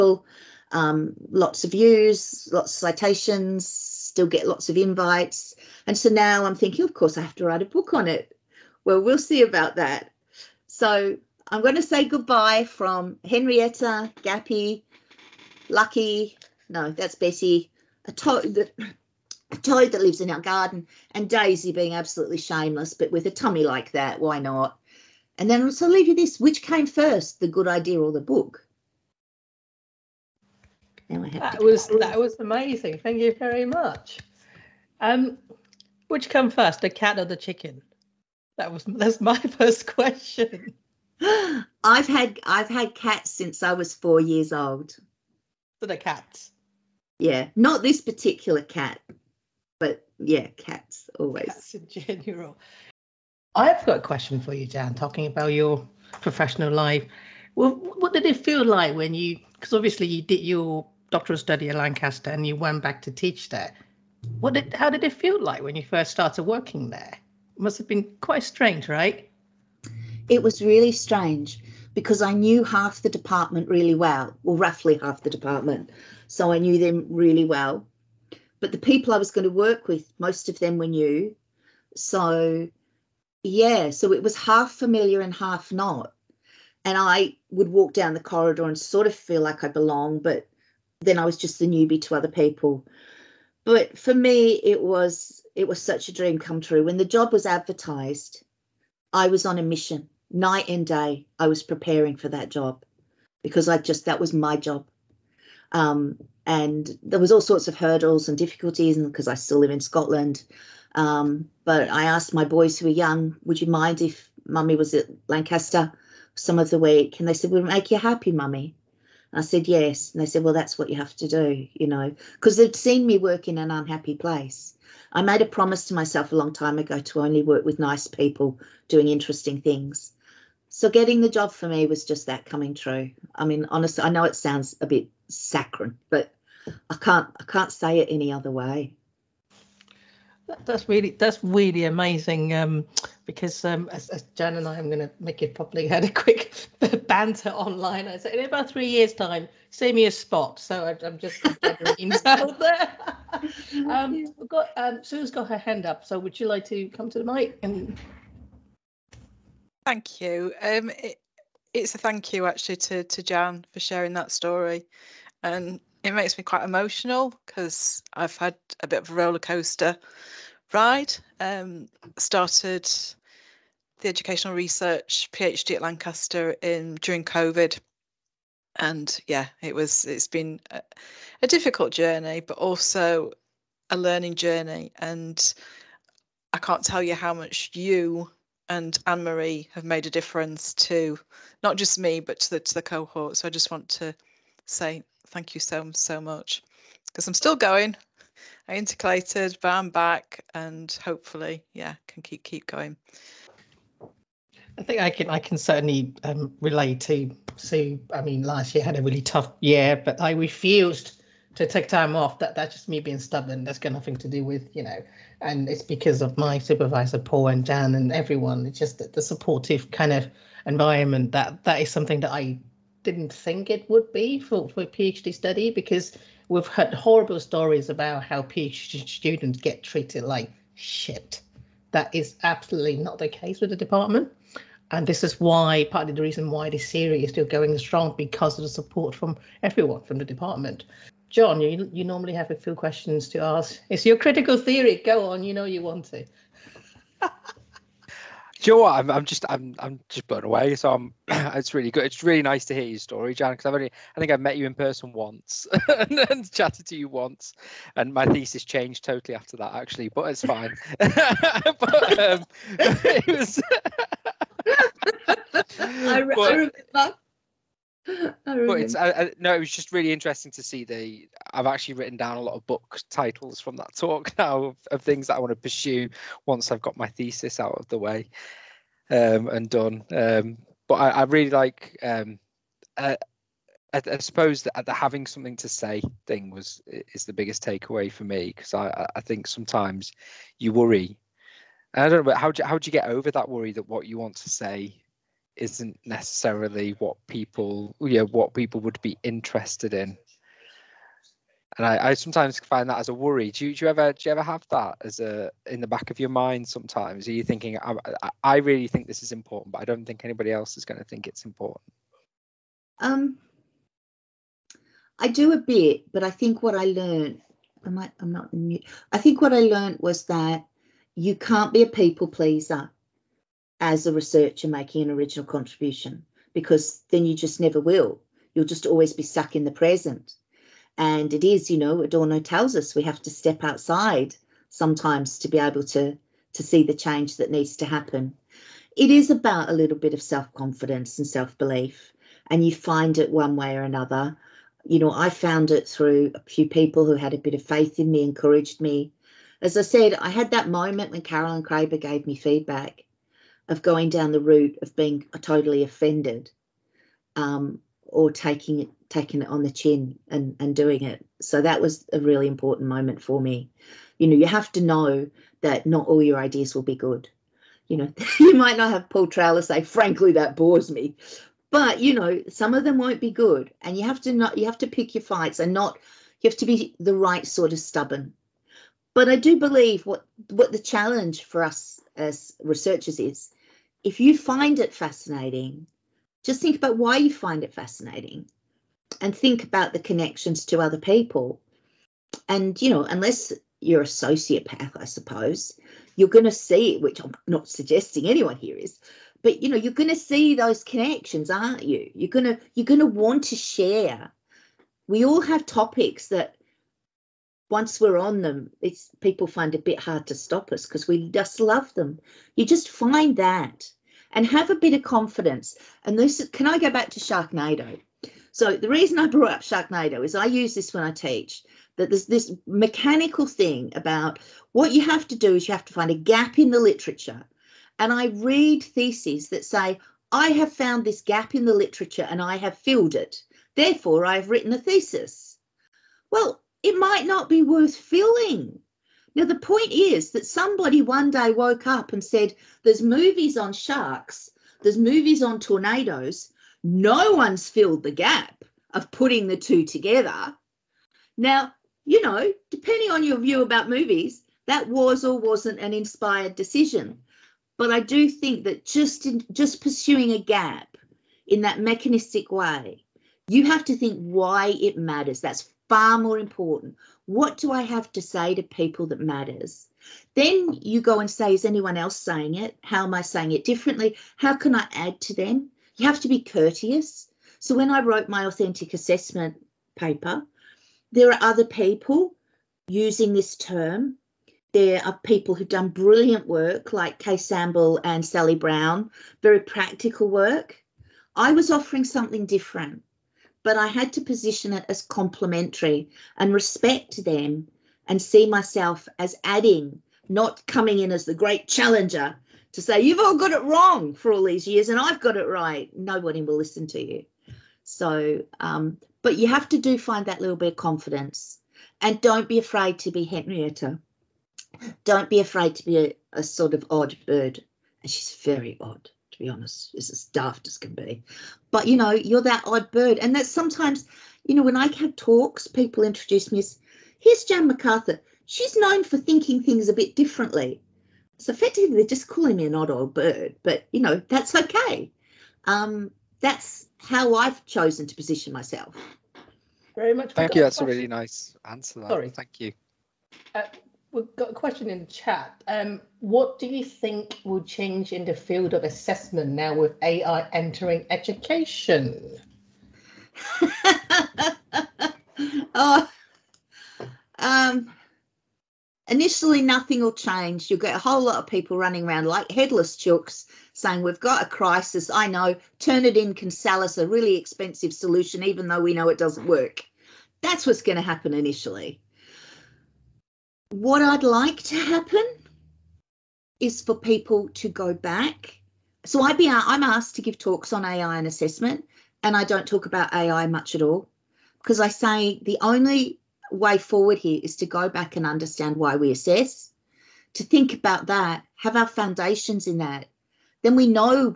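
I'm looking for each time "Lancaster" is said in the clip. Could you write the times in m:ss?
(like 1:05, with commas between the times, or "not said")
1:01, 1:55, 2:55.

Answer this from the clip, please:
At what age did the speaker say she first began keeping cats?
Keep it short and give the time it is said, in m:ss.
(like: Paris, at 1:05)
4, at 0:43.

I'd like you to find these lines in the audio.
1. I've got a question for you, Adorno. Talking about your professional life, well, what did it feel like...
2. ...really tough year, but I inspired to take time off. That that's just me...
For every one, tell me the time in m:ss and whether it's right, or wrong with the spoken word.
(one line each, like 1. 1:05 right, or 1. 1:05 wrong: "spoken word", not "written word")
1. 0:53 wrong: "Dan", not "Adorno"
2. 3:29 wrong: "refused", not "inspired".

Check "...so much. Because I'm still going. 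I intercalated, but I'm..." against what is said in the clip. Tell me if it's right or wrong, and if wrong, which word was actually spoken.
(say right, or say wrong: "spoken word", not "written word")
right.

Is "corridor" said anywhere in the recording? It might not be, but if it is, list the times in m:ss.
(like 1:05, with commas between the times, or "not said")
1:28.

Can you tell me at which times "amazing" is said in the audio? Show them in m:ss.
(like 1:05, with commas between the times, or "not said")
0:32, 2:21.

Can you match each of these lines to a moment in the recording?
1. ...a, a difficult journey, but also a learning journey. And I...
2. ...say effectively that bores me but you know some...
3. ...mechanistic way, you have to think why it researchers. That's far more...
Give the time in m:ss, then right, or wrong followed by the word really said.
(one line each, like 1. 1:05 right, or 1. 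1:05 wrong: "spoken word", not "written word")
1. 3:00 right
2. 6:09 wrong: "frankly", not "effectively"
3. 7:41 wrong: "matters", not "researchers".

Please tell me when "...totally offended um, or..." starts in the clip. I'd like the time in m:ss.
5:55.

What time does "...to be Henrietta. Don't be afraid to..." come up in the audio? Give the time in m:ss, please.
8:32.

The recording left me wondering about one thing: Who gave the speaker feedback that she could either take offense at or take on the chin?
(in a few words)
Carolyn Craver.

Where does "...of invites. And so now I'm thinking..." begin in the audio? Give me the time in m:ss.
0:04.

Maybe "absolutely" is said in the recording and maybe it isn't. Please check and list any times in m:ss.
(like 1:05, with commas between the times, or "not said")
0:21, 3:52.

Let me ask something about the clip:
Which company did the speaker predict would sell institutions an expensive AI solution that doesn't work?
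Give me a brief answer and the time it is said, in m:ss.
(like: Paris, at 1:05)
Turnitin, at 9:25.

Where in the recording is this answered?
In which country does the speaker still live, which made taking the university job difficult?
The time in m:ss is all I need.
1:49.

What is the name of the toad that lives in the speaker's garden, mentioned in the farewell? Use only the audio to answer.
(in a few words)
Bessie.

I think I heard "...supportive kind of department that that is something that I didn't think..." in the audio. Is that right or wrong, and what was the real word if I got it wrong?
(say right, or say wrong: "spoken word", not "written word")
wrong: "environment", not "department".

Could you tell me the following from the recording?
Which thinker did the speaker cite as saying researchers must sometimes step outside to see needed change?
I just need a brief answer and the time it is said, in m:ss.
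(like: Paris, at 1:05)
Adorno, at 5:32.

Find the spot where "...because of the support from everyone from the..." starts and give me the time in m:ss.
3:58.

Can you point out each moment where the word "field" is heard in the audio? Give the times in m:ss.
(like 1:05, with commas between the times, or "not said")
9:08.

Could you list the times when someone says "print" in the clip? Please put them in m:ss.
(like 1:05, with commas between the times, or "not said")
not said.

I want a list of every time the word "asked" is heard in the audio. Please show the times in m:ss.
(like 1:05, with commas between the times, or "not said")
1:52, 9:39.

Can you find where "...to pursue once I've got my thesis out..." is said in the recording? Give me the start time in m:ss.
4:35.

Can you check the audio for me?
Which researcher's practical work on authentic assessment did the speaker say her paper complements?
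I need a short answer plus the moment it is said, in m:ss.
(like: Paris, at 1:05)
Kay Sambell, at 8:07.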